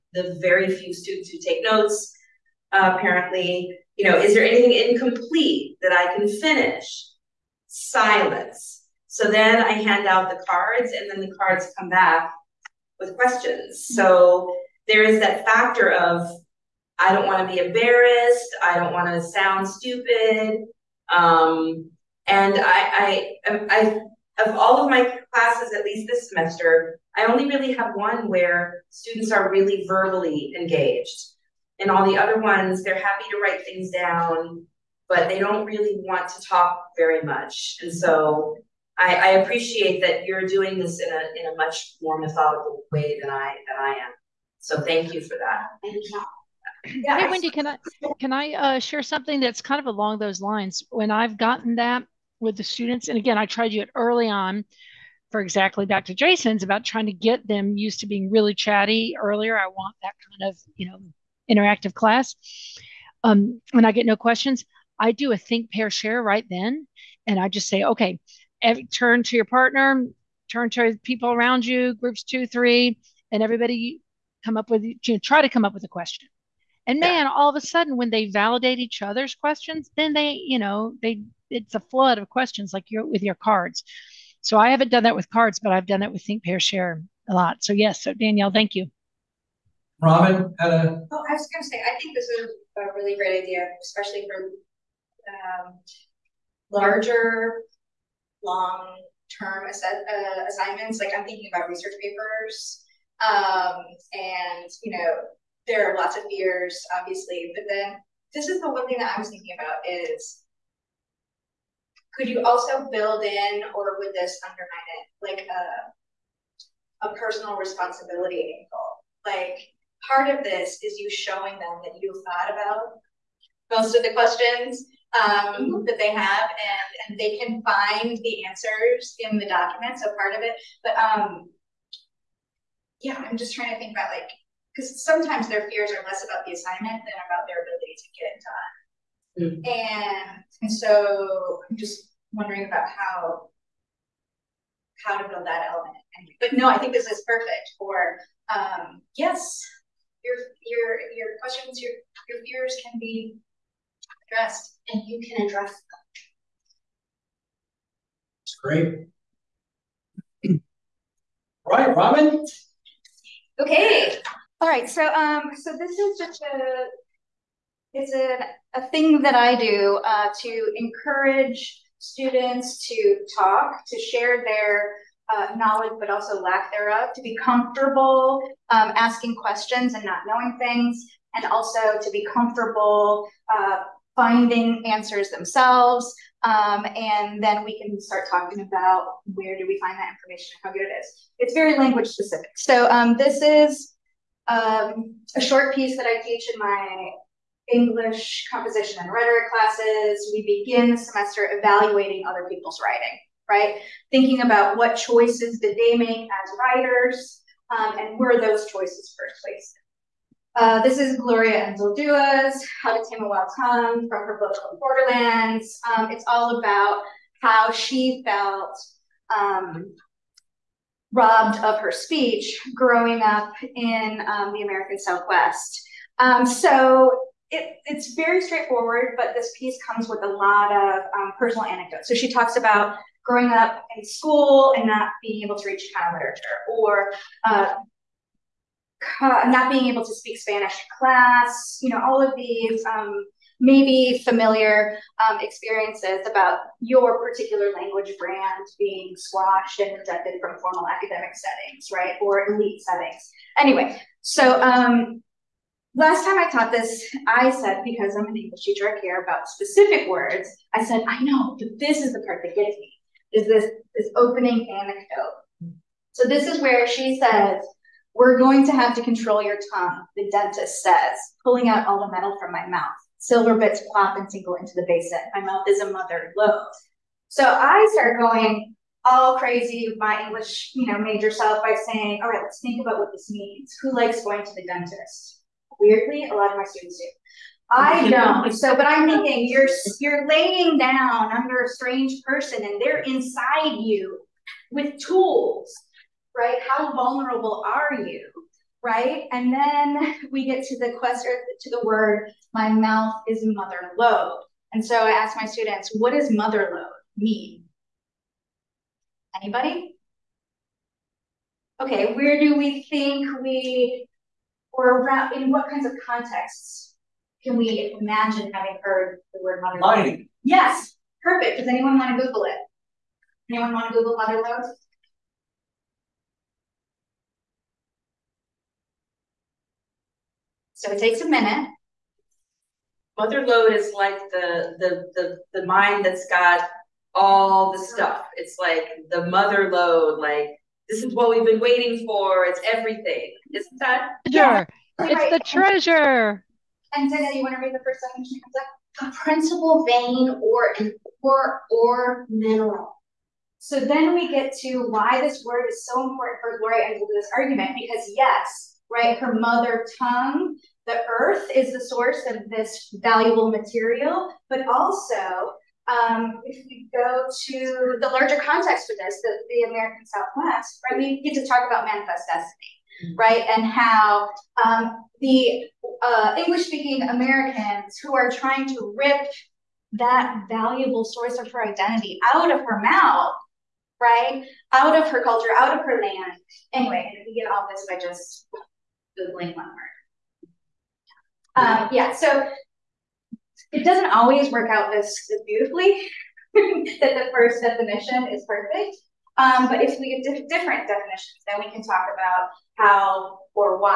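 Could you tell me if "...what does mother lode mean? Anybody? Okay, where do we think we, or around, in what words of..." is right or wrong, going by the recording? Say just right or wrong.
wrong.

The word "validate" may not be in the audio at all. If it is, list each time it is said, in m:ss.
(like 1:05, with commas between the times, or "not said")
1:18.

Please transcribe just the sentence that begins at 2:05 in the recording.
that they have and, and they can find the answers in the document.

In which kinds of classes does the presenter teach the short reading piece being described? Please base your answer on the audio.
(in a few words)
English composition and rhetoric.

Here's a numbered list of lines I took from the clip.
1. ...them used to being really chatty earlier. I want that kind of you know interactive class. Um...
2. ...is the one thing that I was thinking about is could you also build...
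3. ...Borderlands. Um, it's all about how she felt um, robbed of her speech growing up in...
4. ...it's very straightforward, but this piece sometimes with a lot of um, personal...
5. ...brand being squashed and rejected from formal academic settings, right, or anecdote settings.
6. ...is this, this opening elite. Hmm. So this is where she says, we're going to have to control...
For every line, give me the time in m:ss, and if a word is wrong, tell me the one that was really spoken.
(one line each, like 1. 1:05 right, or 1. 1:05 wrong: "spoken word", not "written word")
1. 0:57 right
2. 1:48 right
3. 3:34 right
4. 3:47 wrong: "comes", not "sometimes"
5. 4:08 wrong: "elite", not "anecdote"
6. 4:23 wrong: "anecdote", not "elite".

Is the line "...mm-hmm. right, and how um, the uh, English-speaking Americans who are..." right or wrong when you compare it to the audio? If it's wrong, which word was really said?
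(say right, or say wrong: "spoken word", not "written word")
right.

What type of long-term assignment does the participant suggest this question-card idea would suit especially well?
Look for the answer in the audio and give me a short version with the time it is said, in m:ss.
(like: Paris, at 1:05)
research papers, at 1:41.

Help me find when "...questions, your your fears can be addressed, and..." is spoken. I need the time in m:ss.
2:31.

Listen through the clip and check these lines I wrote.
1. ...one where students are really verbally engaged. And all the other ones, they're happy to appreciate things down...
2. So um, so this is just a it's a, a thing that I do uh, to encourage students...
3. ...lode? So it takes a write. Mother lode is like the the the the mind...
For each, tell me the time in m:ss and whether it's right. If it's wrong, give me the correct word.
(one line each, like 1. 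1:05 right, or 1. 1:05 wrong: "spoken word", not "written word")
1. 0:27 wrong: "write", not "appreciate"
2. 2:44 right
3. 5:24 wrong: "minute", not "write".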